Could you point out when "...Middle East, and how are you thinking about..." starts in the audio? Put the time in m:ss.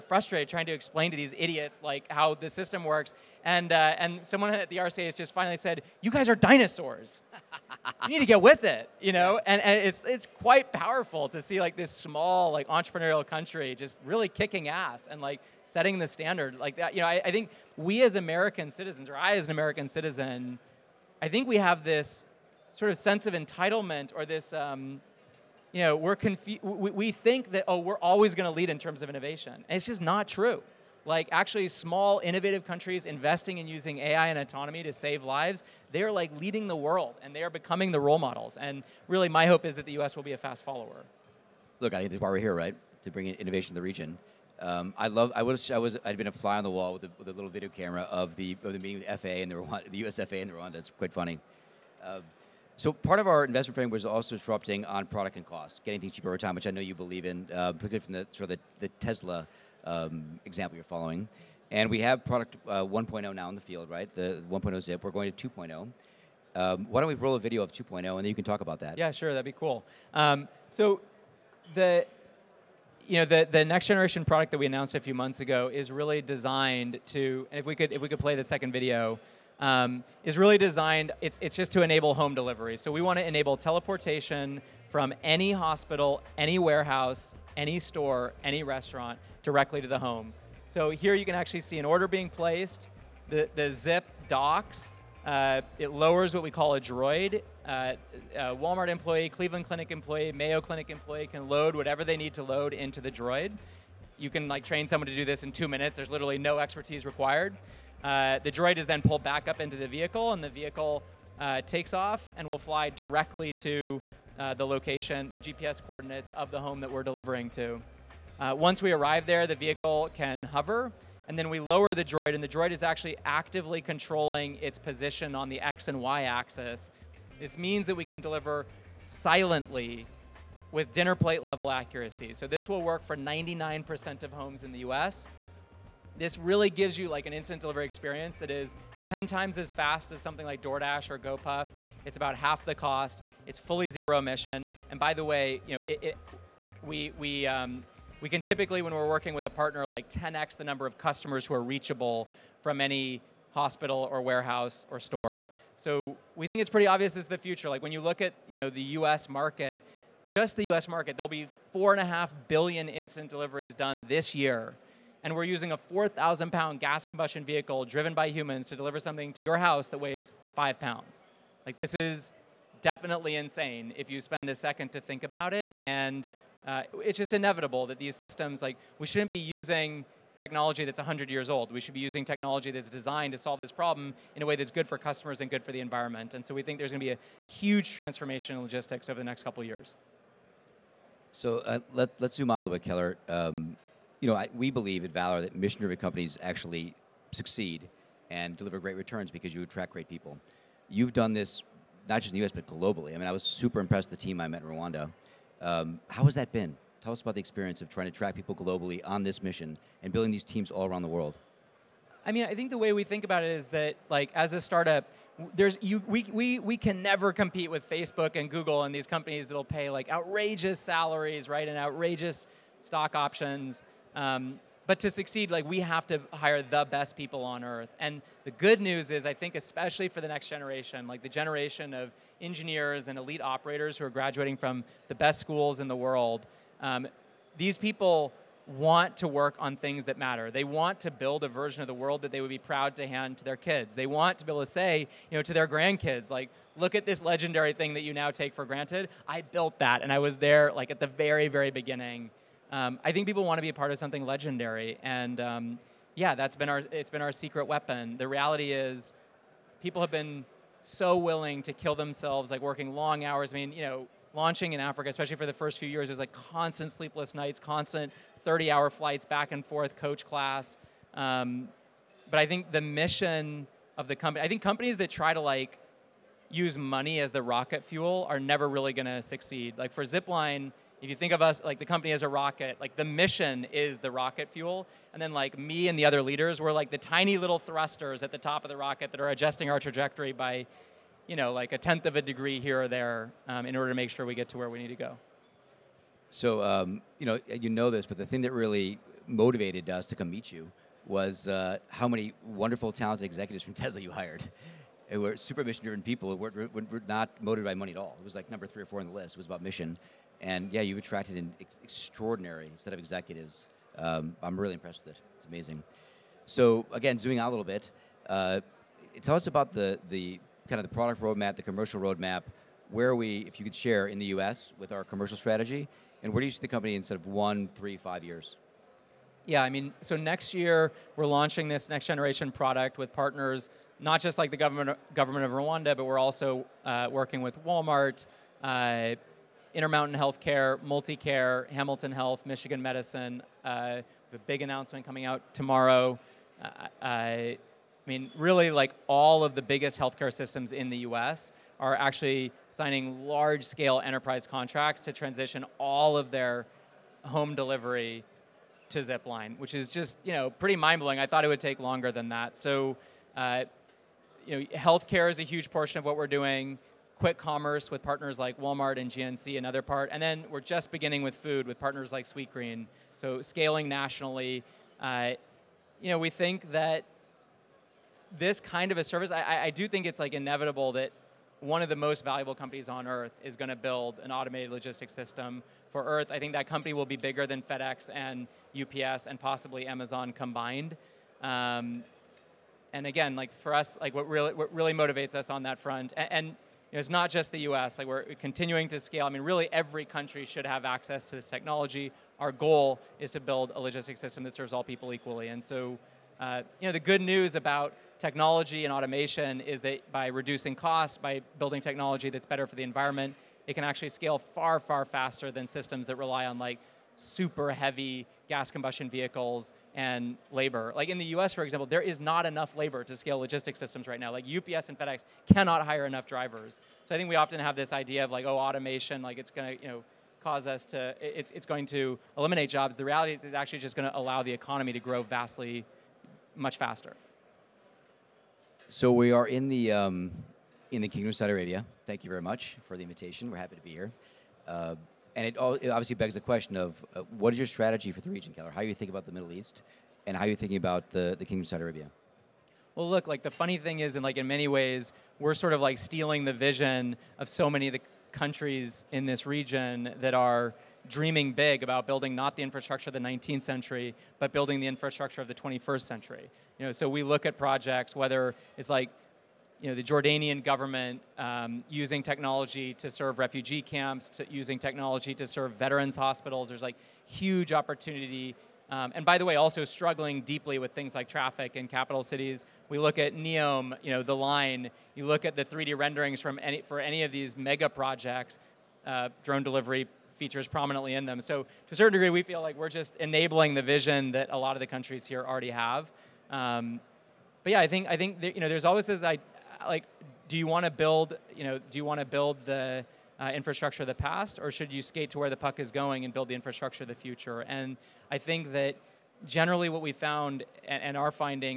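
7:29.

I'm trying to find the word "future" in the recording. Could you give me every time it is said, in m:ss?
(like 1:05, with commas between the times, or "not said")
2:37, 8:27.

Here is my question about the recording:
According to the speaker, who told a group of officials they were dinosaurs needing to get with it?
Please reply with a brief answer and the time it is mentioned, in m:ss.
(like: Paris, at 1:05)
someone at the RCA, at 0:04.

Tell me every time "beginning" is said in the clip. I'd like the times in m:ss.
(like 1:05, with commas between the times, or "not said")
4:11, 6:10.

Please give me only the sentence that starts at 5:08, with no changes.
It was like number three or four on the list.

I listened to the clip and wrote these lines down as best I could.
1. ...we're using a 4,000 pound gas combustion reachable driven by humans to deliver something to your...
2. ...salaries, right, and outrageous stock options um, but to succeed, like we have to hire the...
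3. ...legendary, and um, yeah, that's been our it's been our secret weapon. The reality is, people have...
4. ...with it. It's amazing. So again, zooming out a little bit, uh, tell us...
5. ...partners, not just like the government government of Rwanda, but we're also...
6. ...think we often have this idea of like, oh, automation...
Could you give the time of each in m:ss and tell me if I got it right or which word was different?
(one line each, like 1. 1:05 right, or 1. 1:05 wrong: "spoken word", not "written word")
1. 2:45 wrong: "vehicle", not "reachable"
2. 3:40 right
3. 4:14 right
4. 5:15 right
5. 5:33 right
6. 7:07 right.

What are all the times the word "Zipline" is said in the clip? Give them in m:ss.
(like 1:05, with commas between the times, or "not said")
4:40, 5:58.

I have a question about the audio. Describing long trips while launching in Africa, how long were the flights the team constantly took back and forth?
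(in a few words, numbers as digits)
30 hours.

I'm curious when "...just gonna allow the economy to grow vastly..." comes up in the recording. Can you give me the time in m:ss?
7:13.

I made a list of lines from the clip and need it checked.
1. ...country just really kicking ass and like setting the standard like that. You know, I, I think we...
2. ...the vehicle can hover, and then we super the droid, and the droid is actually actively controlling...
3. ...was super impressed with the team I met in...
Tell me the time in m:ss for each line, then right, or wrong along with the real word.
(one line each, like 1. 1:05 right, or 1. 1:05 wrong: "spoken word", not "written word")
1. 0:13 right
2. 1:59 wrong: "lower", not "super"
3. 3:23 right.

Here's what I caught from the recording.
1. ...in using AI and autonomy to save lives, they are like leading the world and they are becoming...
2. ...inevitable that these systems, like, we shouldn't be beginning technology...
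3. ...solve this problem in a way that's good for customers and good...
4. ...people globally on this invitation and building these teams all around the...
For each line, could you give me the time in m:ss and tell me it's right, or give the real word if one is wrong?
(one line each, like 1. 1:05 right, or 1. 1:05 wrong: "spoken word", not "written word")
1. 0:33 right
2. 2:57 wrong: "using", not "beginning"
3. 3:03 right
4. 3:28 wrong: "mission", not "invitation".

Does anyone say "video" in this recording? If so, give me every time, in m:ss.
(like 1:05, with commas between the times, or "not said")
0:47, 1:07, 1:18.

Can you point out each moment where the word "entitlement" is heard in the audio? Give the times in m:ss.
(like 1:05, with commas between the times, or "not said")
0:23.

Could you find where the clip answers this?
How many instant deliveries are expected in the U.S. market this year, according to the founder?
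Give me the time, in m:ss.
2:41.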